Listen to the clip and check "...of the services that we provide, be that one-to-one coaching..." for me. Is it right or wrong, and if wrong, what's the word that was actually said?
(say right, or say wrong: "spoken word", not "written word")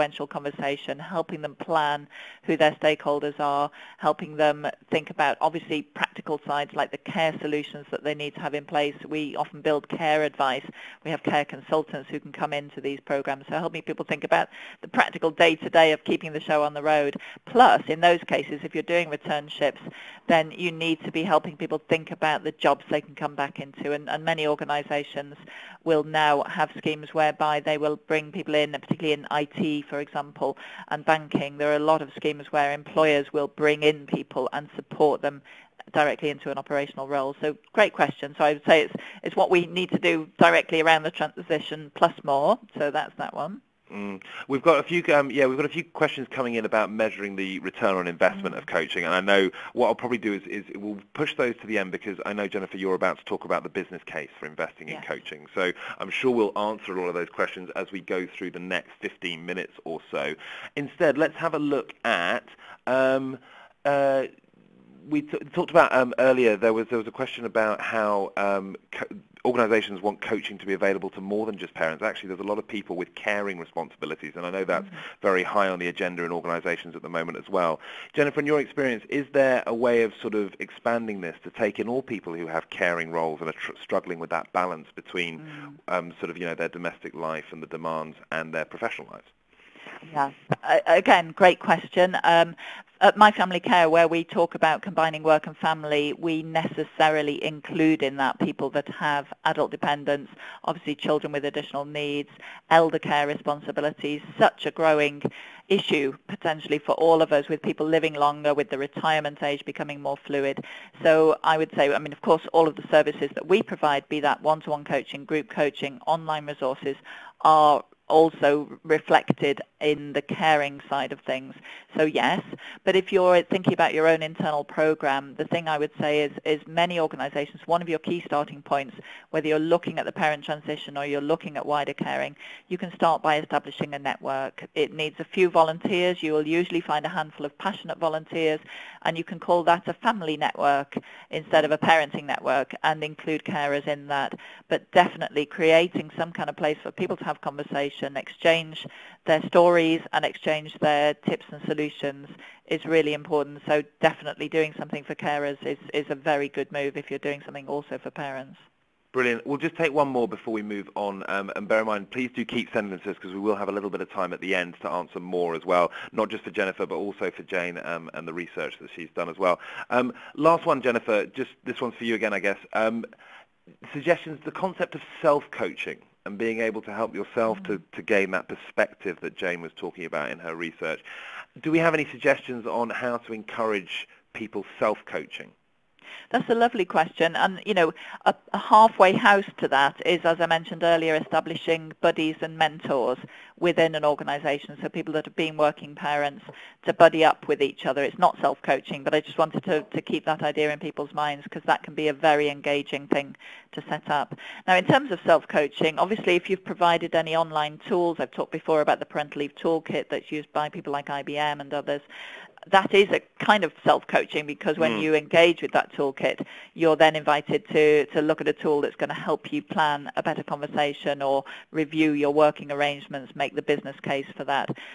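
right.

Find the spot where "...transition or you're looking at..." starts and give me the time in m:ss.
2:10.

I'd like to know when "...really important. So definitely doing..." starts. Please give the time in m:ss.
2:32.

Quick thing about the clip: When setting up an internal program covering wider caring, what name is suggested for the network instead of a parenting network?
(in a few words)
family network.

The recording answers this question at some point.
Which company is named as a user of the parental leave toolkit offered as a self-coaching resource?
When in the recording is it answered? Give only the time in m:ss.
3:31.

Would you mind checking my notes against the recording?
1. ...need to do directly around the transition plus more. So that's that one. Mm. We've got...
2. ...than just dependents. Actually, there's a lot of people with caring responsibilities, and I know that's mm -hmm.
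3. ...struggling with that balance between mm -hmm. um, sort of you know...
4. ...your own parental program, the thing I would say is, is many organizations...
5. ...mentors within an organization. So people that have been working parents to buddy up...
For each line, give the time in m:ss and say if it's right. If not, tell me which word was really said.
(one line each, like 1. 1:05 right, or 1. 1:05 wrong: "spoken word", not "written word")
1. 0:39 right
2. 1:11 wrong: "parents", not "dependents"
3. 1:23 right
4. 2:03 wrong: "internal", not "parental"
5. 3:12 right.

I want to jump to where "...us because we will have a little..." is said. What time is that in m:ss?
2:42.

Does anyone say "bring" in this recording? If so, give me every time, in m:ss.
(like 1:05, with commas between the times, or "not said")
0:27, 0:33.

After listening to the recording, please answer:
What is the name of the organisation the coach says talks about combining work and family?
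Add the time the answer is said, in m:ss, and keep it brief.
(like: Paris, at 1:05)
My Family Care, at 1:33.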